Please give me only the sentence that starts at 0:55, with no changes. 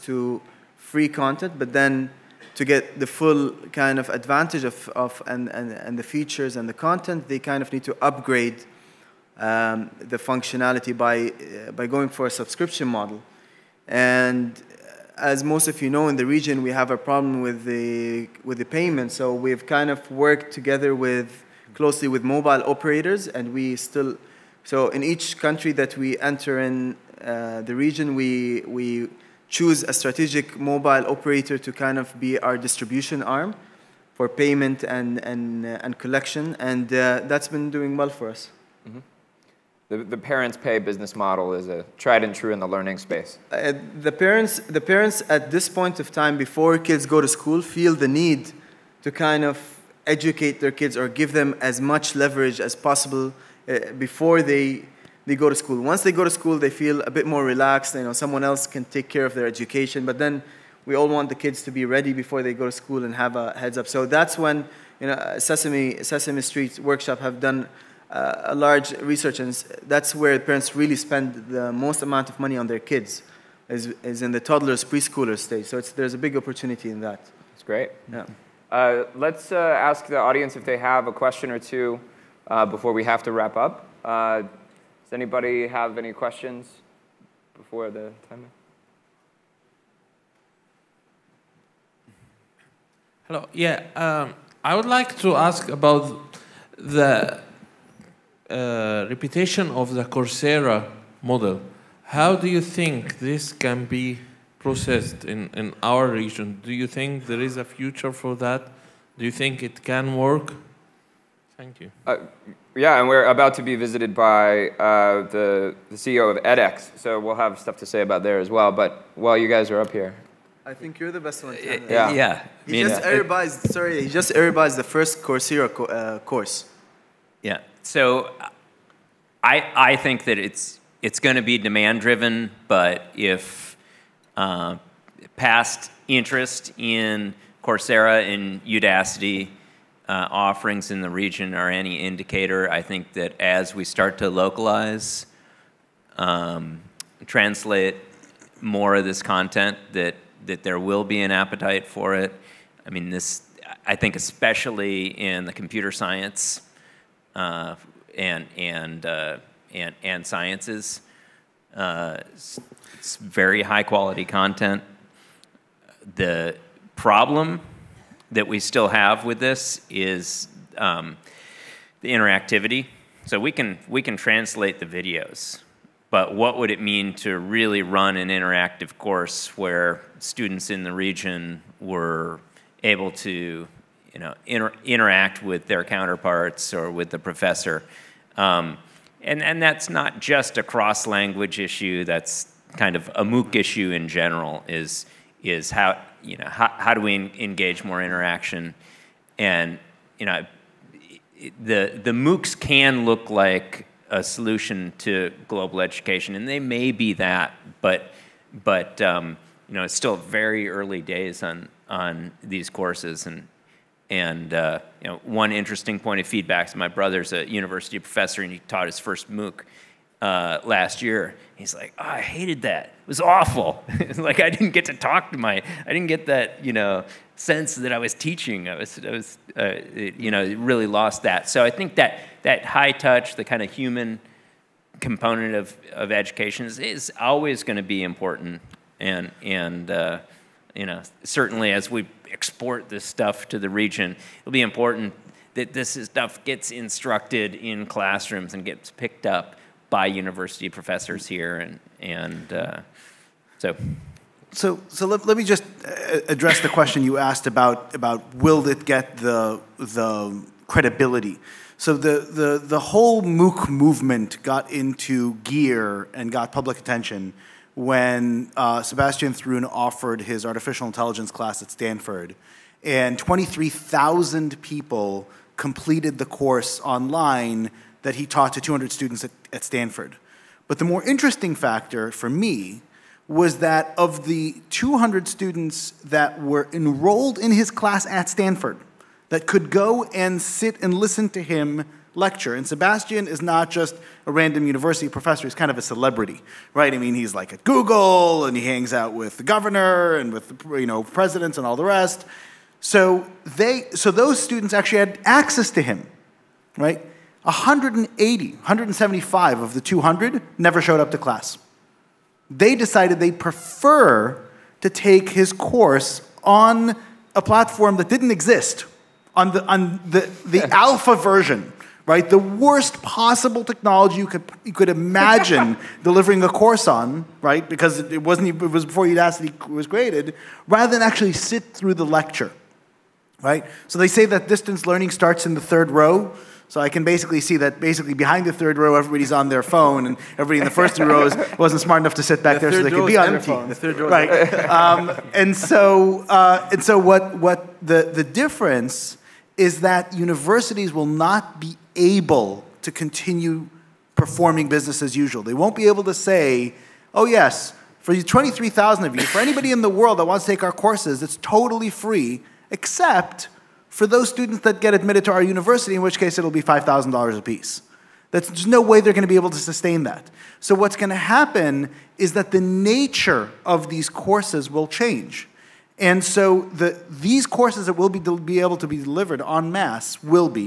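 Once they go to school, they feel a bit more relaxed.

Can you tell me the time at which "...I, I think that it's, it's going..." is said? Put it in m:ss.
2:09.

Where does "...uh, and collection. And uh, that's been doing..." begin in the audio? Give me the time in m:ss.
0:35.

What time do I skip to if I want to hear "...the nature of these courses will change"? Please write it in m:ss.
6:12.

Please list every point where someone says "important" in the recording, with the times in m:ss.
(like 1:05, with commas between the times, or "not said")
3:58, 4:04.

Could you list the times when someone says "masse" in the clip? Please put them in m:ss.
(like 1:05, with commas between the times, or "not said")
6:19.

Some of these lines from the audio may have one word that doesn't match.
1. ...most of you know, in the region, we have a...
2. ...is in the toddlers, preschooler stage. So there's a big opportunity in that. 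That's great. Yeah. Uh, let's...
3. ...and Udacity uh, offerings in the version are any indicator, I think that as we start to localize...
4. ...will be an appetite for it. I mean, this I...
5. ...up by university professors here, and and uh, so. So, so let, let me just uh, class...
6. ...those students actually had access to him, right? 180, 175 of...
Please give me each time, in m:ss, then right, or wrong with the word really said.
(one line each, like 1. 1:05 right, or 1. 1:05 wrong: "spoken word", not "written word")
1. 0:15 right
2. 1:14 right
3. 2:18 wrong: "region", not "version"
4. 2:30 right
5. 4:09 wrong: "address", not "class"
6. 5:04 right.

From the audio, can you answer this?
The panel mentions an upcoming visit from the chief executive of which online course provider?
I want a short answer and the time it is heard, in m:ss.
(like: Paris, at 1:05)
edX, at 1:56.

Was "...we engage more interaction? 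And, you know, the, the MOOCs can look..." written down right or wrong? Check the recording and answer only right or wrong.
right.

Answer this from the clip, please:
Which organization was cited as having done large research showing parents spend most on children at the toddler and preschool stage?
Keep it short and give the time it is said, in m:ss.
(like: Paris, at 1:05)
Sesame Street Workshop, at 1:06.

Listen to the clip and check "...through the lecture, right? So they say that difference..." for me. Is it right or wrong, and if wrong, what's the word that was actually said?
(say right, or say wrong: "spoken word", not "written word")
wrong: "distance", not "difference".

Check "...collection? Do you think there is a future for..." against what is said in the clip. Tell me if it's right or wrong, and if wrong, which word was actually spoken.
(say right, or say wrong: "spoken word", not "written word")
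wrong: "region", not "collection".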